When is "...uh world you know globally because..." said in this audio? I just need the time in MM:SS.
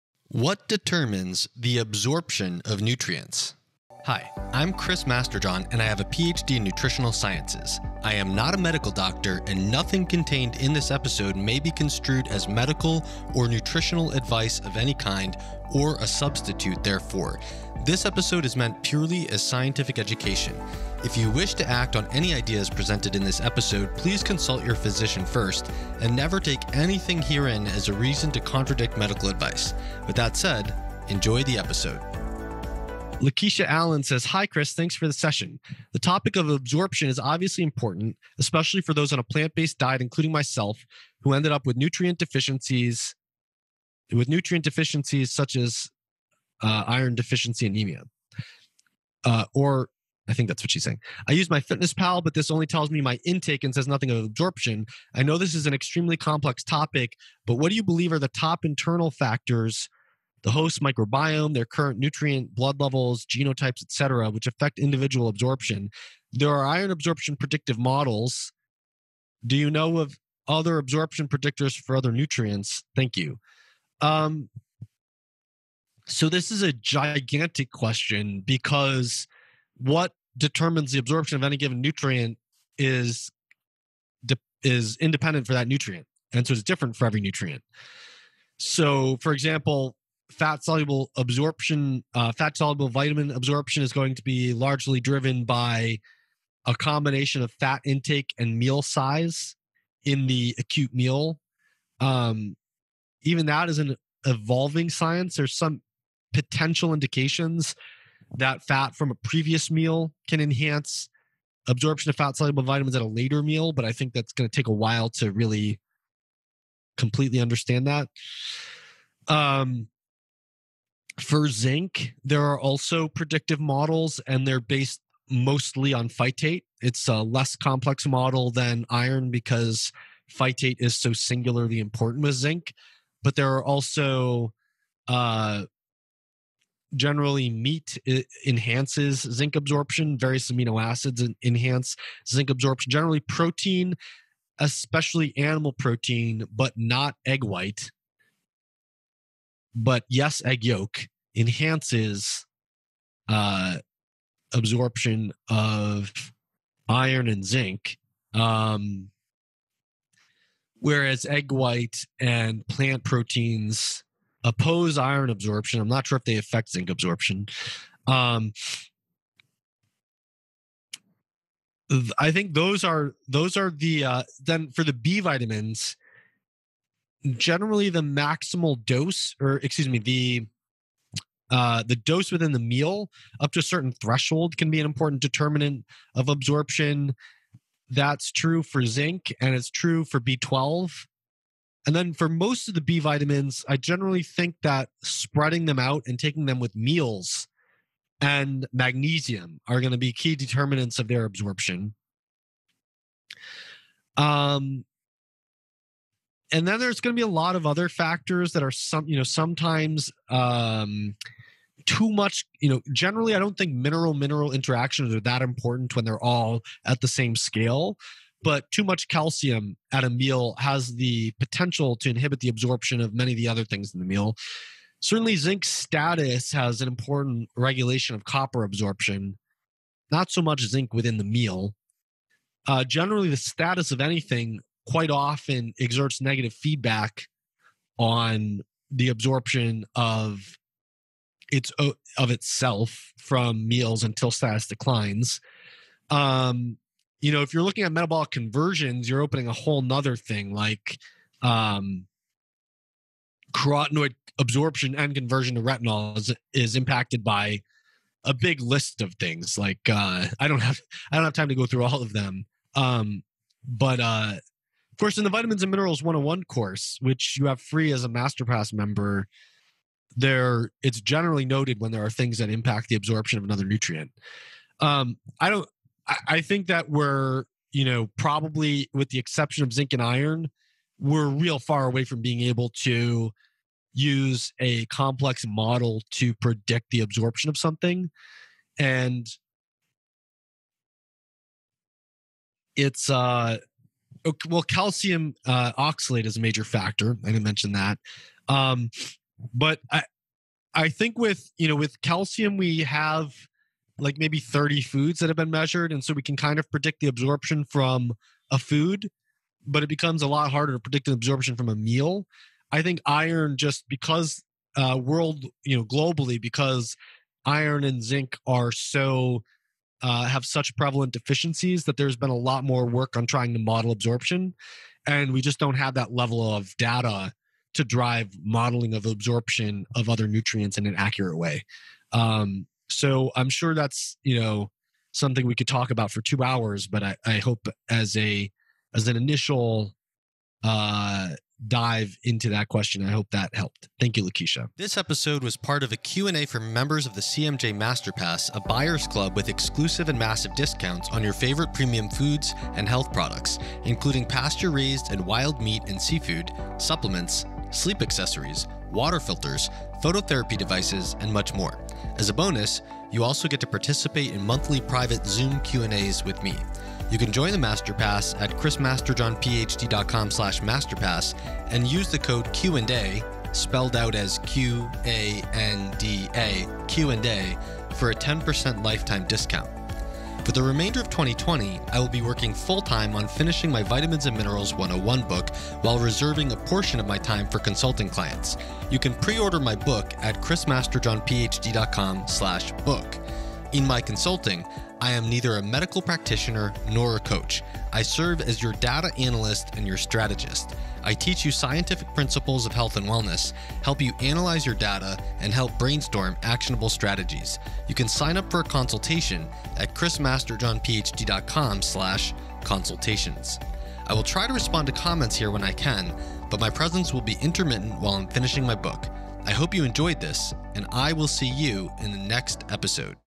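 05:14.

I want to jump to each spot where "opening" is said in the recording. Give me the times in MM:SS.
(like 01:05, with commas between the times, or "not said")
04:09.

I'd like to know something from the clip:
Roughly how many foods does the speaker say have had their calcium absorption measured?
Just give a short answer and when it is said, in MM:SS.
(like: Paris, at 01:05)
30, at 05:04.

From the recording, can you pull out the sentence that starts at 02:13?
But there are also uh, generally meat enhances zinc absorption, various amino acids enhance zinc absorption.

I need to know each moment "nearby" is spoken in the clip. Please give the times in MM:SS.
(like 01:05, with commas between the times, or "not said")
not said.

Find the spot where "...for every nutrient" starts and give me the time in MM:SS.
01:26.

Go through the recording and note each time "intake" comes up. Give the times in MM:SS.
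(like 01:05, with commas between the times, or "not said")
00:53, 01:37.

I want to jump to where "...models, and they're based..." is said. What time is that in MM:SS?
02:03.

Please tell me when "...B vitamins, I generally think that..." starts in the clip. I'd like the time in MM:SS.
03:12.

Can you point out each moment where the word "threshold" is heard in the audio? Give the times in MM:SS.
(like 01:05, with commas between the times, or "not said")
03:03.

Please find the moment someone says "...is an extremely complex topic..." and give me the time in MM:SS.
00:55.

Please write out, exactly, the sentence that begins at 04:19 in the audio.
Like uh, I don't have I don't have time to go through all of them.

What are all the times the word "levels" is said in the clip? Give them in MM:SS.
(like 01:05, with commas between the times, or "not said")
01:02, 05:26.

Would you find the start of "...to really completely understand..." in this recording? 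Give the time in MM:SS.
01:55.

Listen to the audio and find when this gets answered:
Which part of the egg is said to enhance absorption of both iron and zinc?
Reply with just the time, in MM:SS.
02:30.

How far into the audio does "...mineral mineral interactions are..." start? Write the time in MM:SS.
03:33.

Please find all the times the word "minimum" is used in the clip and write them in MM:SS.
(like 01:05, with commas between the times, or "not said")
not said.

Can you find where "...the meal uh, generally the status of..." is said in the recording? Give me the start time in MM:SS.
03:51.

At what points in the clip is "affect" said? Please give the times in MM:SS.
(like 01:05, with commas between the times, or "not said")
01:04, 02:46.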